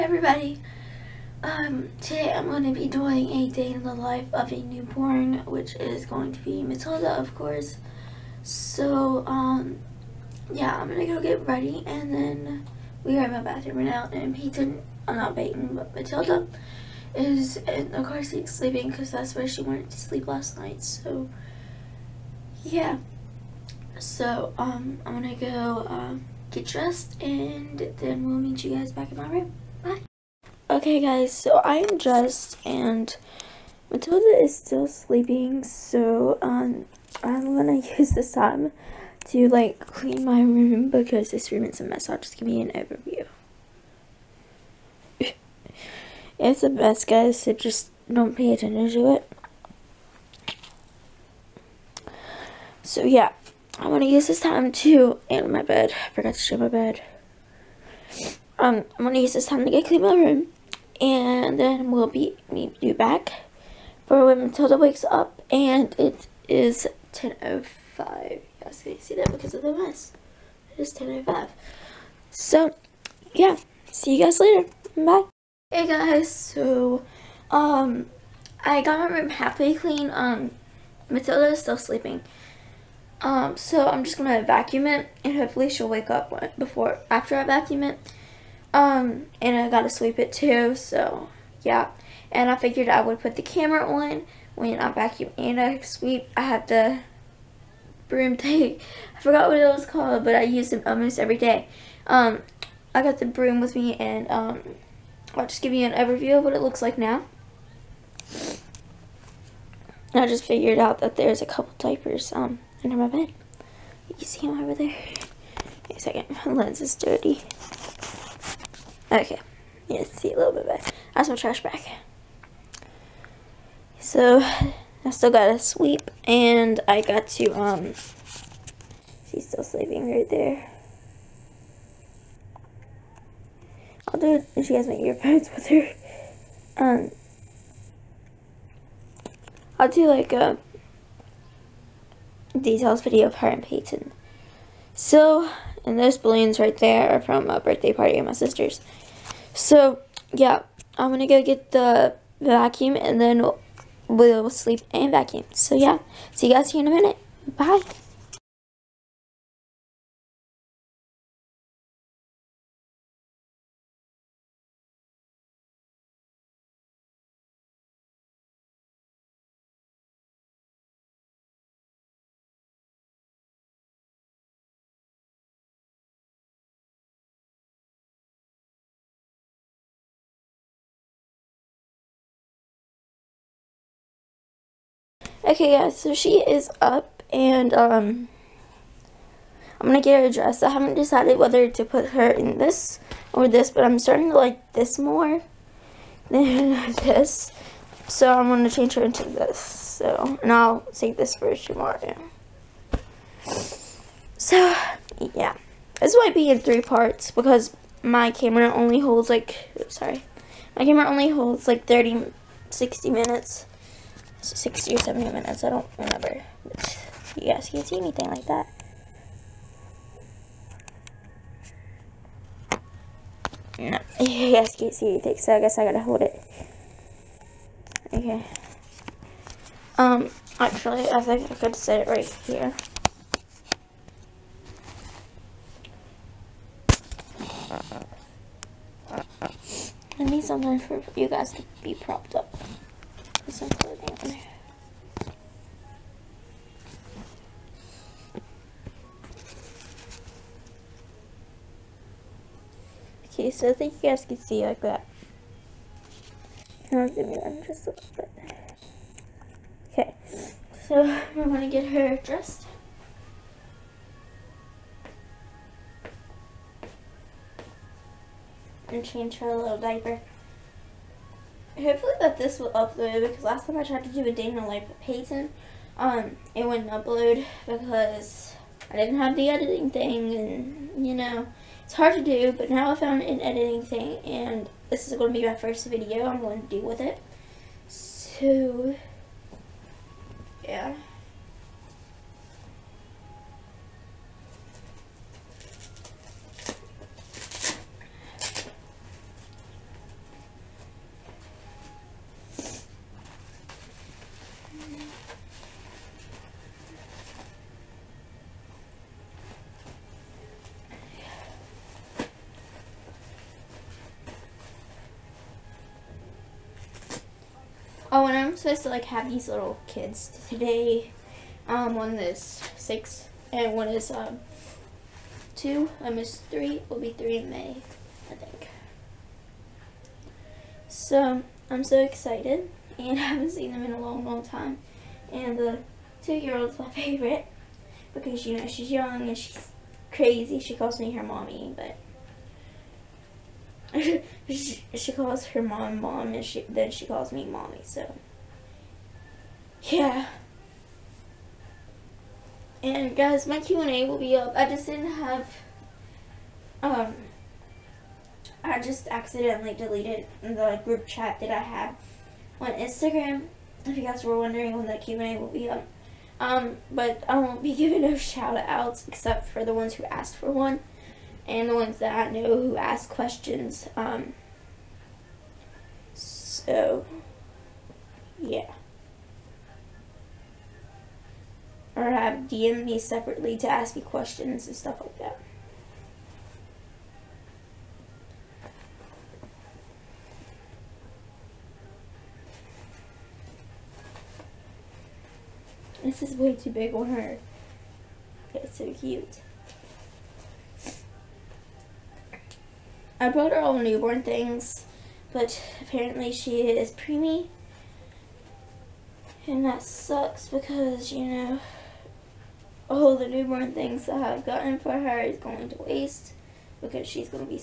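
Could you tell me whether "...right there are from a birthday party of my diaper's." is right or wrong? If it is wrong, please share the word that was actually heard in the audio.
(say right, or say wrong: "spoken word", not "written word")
wrong: "sister", not "diaper".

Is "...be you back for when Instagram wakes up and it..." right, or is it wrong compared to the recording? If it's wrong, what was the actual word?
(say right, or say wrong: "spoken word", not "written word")
wrong: "Matilda", not "Instagram".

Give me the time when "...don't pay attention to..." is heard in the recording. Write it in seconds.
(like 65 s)
48 s.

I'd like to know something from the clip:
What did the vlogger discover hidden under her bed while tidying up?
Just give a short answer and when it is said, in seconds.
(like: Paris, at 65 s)
diapers, at 111 s.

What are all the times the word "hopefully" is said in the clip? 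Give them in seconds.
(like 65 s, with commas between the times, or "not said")
85 s, 271 s.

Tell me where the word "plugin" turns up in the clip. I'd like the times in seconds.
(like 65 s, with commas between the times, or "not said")
not said.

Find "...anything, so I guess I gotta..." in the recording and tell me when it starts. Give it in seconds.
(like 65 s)
225 s.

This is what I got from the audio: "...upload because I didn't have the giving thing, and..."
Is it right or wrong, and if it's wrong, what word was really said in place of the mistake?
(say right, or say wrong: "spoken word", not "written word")
wrong: "editing", not "giving".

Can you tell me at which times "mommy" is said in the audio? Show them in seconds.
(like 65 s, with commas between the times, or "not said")
341 s, 347 s.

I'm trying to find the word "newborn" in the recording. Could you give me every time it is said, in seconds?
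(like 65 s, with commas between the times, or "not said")
4 s, 403 s, 413 s.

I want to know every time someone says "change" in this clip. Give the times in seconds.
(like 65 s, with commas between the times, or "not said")
198 s, 269 s.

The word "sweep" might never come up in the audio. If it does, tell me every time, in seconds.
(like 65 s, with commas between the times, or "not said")
89 s, 95 s, 125 s.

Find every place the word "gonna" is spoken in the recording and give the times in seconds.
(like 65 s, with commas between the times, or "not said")
37 s, 53 s, 59 s, 84 s, 151 s, 189 s, 198 s, 261 s.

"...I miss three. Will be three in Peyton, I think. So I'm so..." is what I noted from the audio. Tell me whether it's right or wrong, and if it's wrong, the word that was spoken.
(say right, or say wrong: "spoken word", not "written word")
wrong: "May", not "Peyton".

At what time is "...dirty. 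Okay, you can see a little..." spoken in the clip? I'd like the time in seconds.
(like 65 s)
116 s.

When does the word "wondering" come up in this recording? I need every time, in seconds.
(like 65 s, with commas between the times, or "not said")
364 s.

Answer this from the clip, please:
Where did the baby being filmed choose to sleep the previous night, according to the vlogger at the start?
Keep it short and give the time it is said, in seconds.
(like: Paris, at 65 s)
car seat, at 18 s.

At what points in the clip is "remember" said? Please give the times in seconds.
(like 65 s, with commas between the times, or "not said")
215 s.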